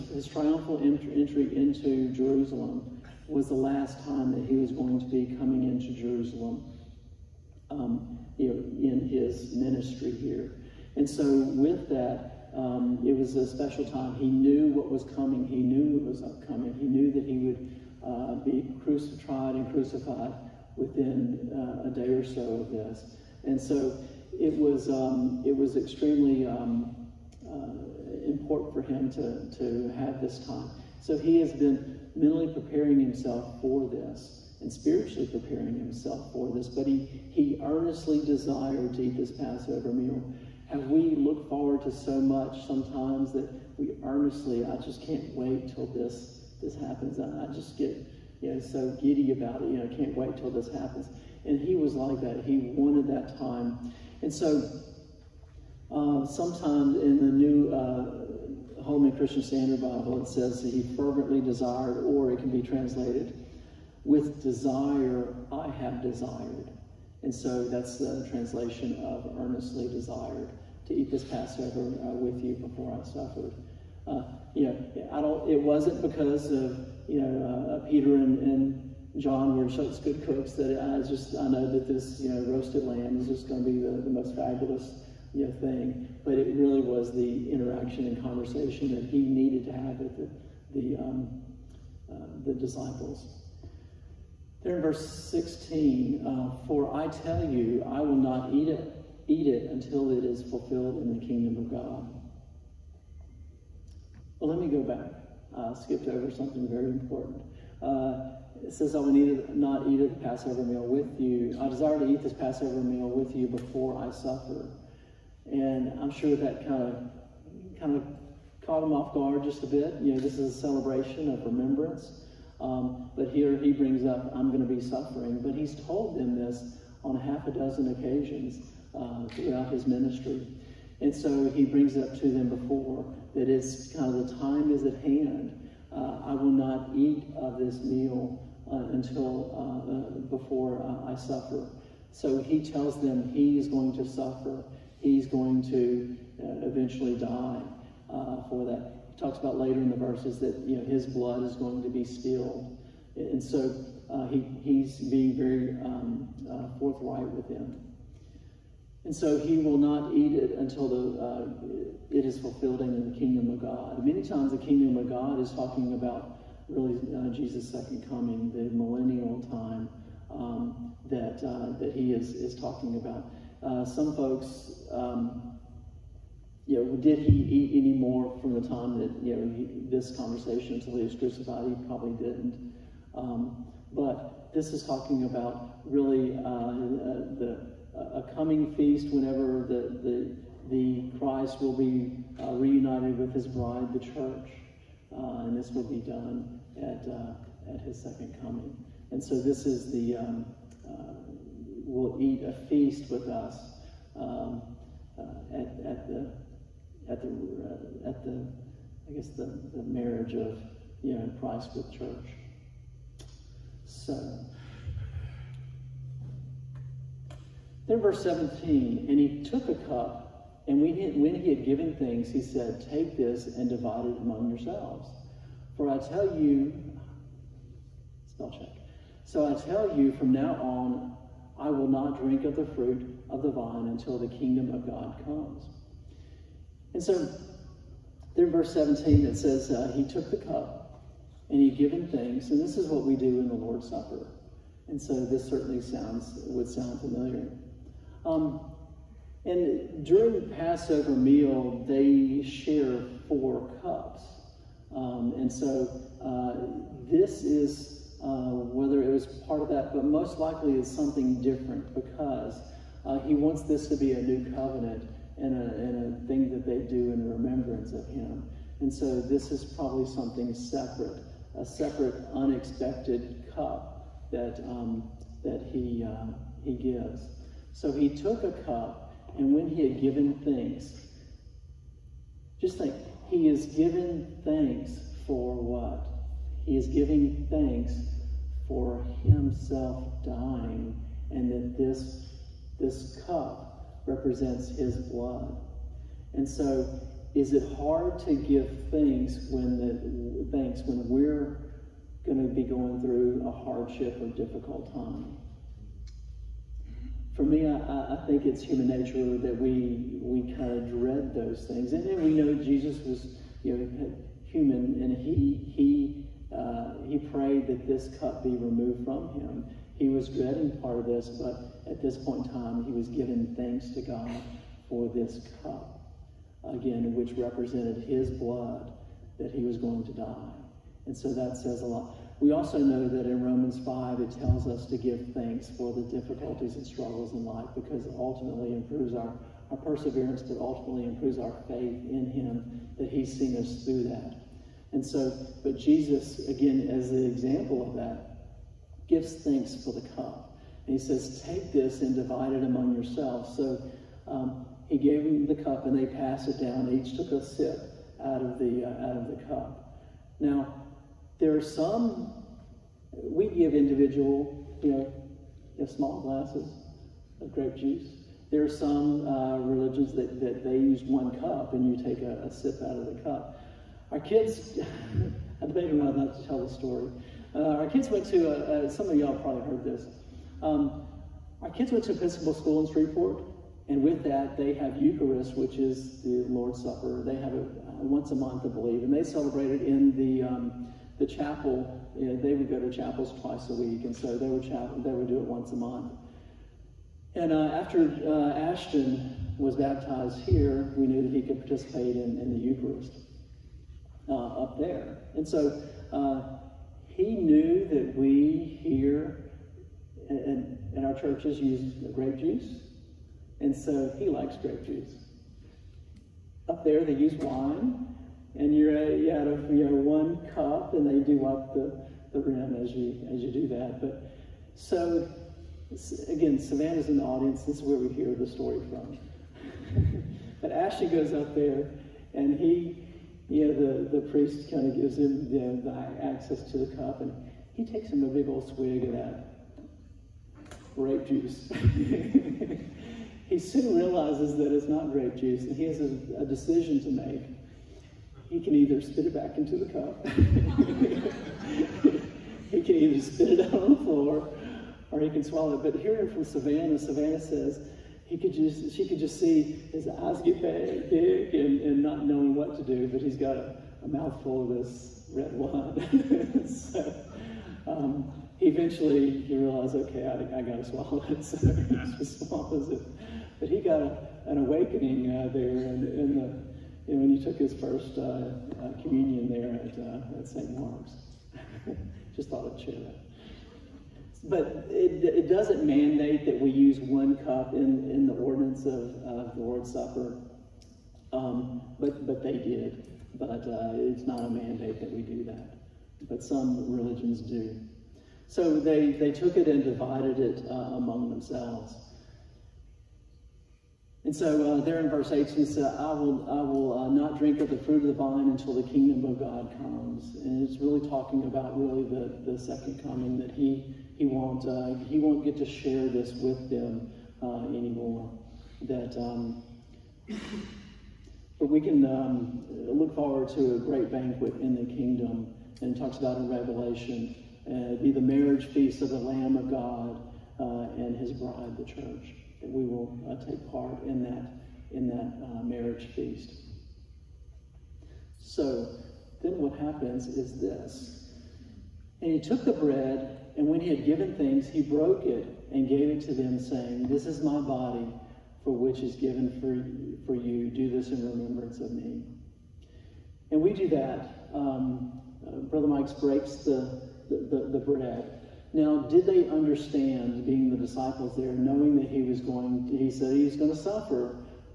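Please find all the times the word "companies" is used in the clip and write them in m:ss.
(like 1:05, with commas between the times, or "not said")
not said.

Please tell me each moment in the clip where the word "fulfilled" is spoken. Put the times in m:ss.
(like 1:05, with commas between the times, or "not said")
1:40, 2:42.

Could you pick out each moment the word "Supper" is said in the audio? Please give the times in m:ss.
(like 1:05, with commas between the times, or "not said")
4:03, 6:26, 8:09.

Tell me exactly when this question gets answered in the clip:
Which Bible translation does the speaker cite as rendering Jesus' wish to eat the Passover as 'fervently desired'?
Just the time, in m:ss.
0:58.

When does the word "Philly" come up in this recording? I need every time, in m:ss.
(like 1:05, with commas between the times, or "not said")
not said.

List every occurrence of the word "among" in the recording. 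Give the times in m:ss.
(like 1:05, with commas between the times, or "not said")
3:44, 5:52, 8:21.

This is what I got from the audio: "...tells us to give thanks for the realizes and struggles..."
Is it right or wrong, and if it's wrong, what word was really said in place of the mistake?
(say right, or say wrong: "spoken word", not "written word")
wrong: "difficulties", not "realizes".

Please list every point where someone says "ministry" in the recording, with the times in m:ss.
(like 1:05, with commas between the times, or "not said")
0:09, 2:09.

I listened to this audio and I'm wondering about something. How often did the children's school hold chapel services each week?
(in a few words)
twice a week.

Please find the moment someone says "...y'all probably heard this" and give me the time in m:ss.
6:19.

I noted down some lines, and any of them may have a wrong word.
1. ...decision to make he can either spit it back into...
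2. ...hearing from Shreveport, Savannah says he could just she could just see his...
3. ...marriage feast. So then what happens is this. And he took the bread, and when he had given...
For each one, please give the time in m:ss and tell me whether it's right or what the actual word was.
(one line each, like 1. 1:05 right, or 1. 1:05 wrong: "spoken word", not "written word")
1. 7:26 right
2. 7:36 wrong: "Savannah", not "Shreveport"
3. 8:55 right.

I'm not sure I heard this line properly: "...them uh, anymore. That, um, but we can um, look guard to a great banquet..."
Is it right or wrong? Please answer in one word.
wrong.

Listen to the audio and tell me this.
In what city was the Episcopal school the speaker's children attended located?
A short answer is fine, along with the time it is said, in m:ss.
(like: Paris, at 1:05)
Shreveport, at 6:22.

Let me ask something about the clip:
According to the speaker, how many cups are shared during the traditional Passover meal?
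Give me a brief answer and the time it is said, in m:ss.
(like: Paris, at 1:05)
4, at 4:13.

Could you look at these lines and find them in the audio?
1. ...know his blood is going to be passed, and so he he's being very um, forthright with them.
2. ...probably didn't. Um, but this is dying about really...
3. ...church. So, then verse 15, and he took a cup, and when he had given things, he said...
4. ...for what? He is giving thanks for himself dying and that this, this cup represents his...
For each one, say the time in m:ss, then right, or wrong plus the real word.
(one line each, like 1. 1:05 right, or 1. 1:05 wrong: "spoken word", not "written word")
1. 2:30 wrong: "spilled", not "passed"
2. 3:01 wrong: "talking", not "dying"
3. 3:31 wrong: "17", not "15"
4. 4:45 right.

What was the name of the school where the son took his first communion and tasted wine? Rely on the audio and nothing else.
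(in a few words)
St. Mark's.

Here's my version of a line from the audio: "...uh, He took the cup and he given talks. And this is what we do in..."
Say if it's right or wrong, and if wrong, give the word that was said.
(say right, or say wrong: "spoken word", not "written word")
wrong: "thanks", not "talks".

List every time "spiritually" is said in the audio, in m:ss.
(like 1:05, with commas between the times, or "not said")
0:34.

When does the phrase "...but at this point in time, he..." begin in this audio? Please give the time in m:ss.
5:21.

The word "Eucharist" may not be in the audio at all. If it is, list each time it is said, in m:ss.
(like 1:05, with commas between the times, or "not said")
6:25, 6:42.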